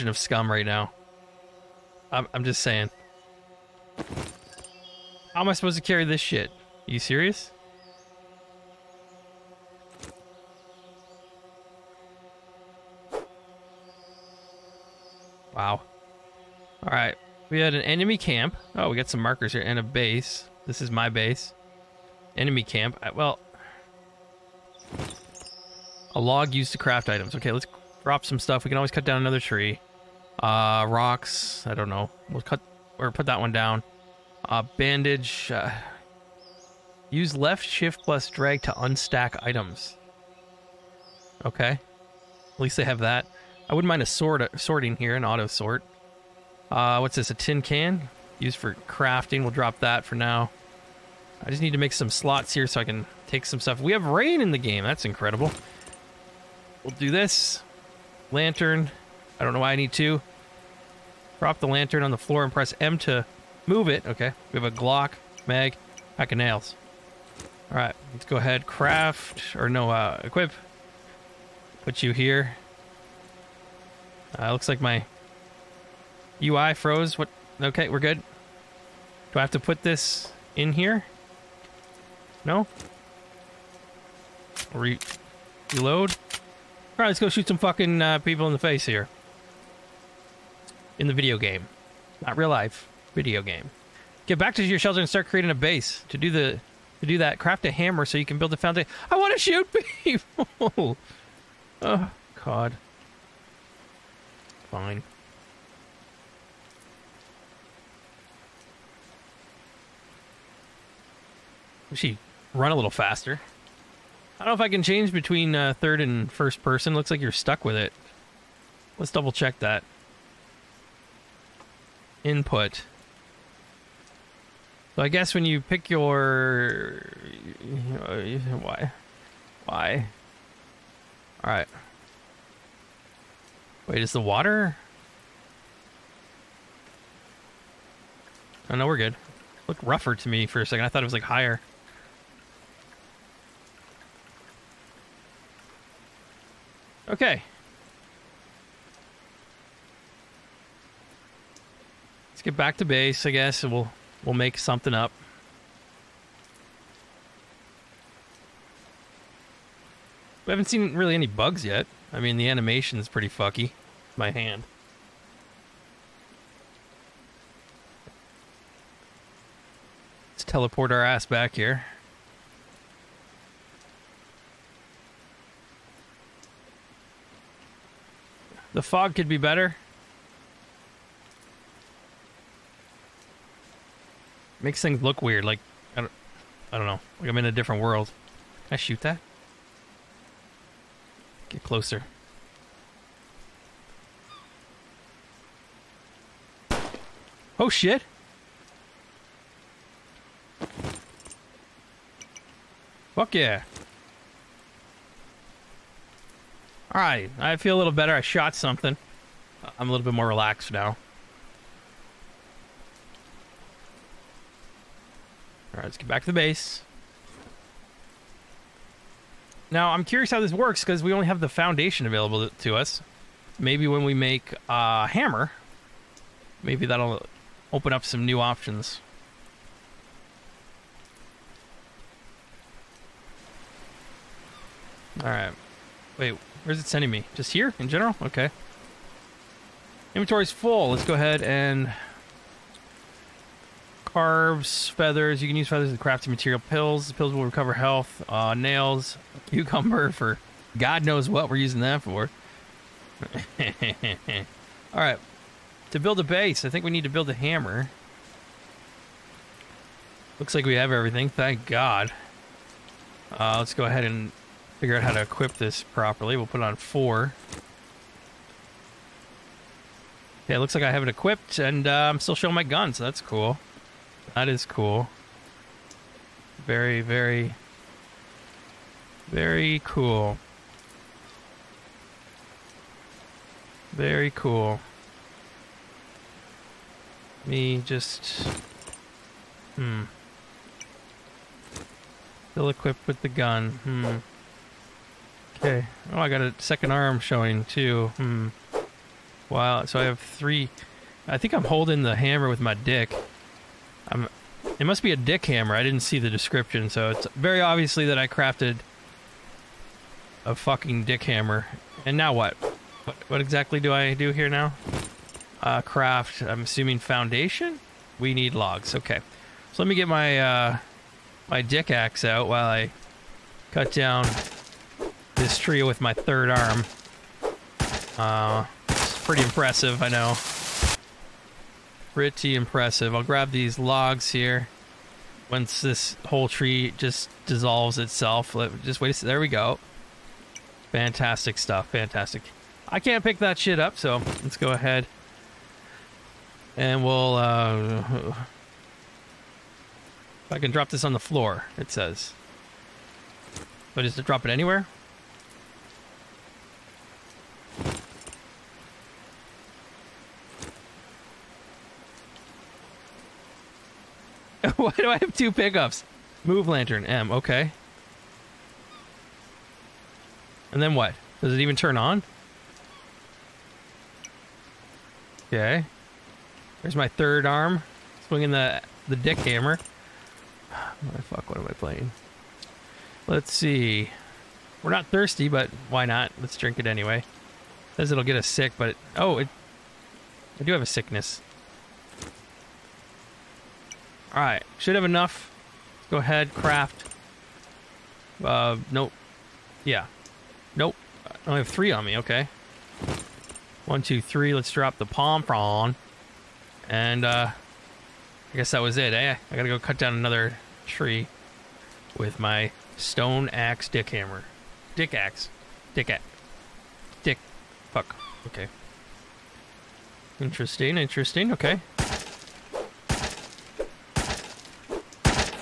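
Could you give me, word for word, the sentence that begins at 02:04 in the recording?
So I guess when you pick your, uh, why, why?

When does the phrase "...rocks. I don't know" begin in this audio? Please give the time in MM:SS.
00:30.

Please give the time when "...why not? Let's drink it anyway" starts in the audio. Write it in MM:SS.
06:25.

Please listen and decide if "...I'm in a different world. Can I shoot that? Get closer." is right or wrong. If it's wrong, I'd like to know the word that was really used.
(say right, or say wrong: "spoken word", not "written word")
right.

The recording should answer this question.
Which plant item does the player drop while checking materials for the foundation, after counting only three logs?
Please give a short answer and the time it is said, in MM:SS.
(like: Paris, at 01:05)
palm frond, at 06:45.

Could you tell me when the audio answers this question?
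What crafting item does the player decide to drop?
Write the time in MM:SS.
00:47.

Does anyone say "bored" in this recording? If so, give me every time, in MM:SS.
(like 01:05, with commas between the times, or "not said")
not said.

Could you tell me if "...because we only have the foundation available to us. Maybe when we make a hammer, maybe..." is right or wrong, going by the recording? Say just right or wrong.
right.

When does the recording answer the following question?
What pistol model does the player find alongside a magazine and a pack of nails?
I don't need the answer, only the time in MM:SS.
01:04.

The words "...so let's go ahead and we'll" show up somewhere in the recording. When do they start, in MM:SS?
05:43.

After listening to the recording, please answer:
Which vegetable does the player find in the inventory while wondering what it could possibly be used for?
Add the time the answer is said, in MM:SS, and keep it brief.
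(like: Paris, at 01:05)
cucumber, at 04:09.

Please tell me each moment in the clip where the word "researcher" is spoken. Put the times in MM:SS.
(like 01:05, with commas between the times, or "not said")
not said.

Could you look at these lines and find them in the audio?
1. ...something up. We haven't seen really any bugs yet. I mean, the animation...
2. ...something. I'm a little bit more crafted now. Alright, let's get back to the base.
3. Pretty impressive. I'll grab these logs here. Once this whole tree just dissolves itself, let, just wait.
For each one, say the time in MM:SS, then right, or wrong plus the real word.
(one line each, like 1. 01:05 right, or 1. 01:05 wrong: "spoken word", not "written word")
1. 02:34 right
2. 03:28 wrong: "relaxed", not "crafted"
3. 05:32 right.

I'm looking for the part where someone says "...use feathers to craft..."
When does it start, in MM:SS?
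04:05.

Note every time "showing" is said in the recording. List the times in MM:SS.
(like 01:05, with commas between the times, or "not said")
04:32, 04:57.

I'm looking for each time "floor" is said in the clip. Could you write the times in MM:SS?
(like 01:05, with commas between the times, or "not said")
01:02, 05:51.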